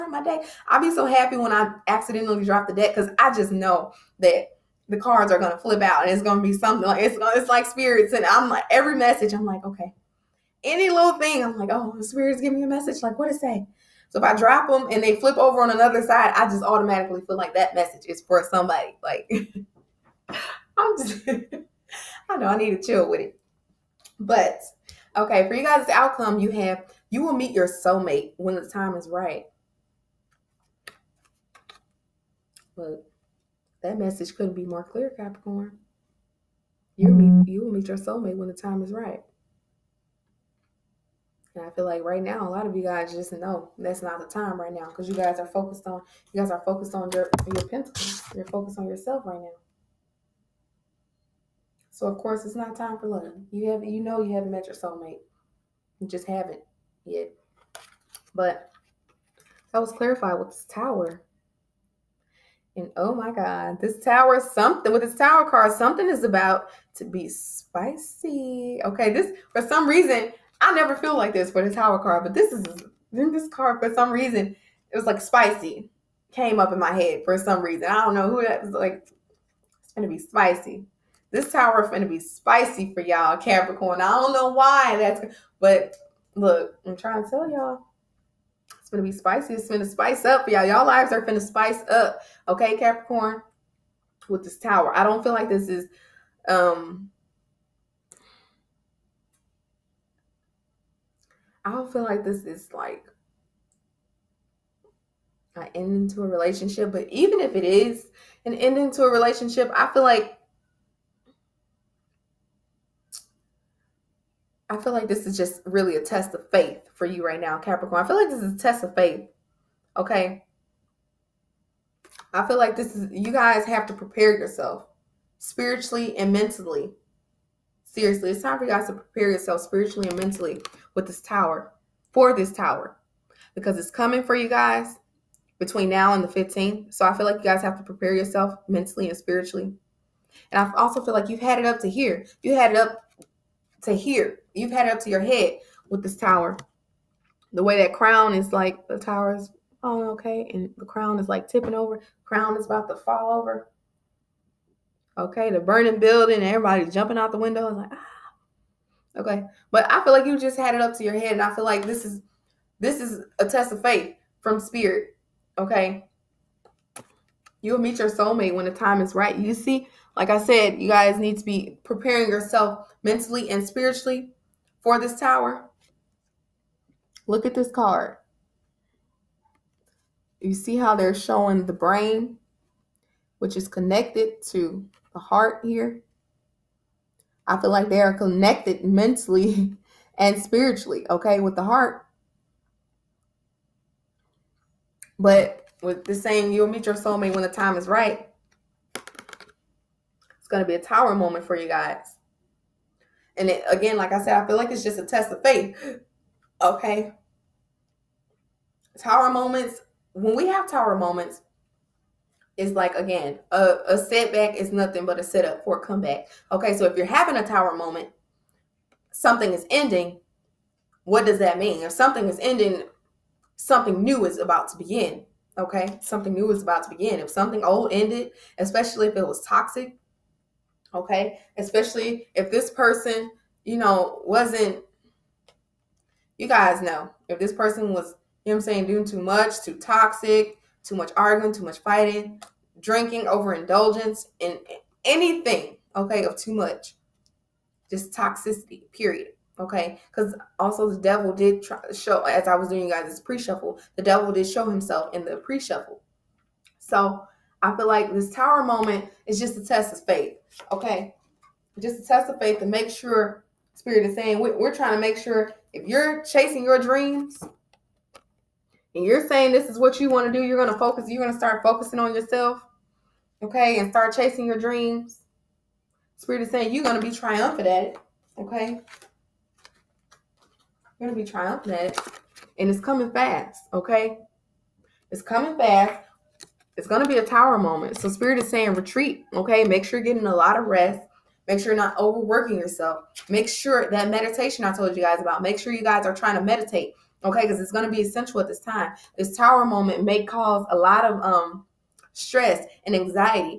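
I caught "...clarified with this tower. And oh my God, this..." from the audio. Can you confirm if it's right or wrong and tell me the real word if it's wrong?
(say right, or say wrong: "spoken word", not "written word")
right.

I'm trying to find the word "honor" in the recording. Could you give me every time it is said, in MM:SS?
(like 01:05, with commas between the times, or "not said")
not said.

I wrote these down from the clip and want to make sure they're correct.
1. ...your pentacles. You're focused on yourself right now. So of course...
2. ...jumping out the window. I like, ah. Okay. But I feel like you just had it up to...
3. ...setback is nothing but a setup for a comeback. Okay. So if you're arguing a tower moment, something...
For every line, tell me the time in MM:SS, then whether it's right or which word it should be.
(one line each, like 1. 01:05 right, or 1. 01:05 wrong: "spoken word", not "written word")
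1. 00:47 right
2. 02:36 right
3. 03:33 wrong: "having", not "arguing".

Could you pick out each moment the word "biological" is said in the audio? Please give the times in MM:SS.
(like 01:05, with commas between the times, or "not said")
not said.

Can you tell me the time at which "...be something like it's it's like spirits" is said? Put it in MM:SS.
00:06.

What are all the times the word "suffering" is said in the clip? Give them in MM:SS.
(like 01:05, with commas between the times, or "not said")
not said.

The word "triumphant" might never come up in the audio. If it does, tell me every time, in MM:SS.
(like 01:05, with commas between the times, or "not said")
04:37, 04:41.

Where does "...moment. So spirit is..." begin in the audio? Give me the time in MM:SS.
04:47.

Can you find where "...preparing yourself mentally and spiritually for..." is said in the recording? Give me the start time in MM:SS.
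02:51.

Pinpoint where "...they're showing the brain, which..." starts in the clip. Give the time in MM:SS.
03:00.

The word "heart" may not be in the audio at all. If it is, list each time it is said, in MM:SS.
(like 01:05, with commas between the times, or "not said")
03:05, 03:11.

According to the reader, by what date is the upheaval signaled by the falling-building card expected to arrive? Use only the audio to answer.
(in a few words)
the 15th.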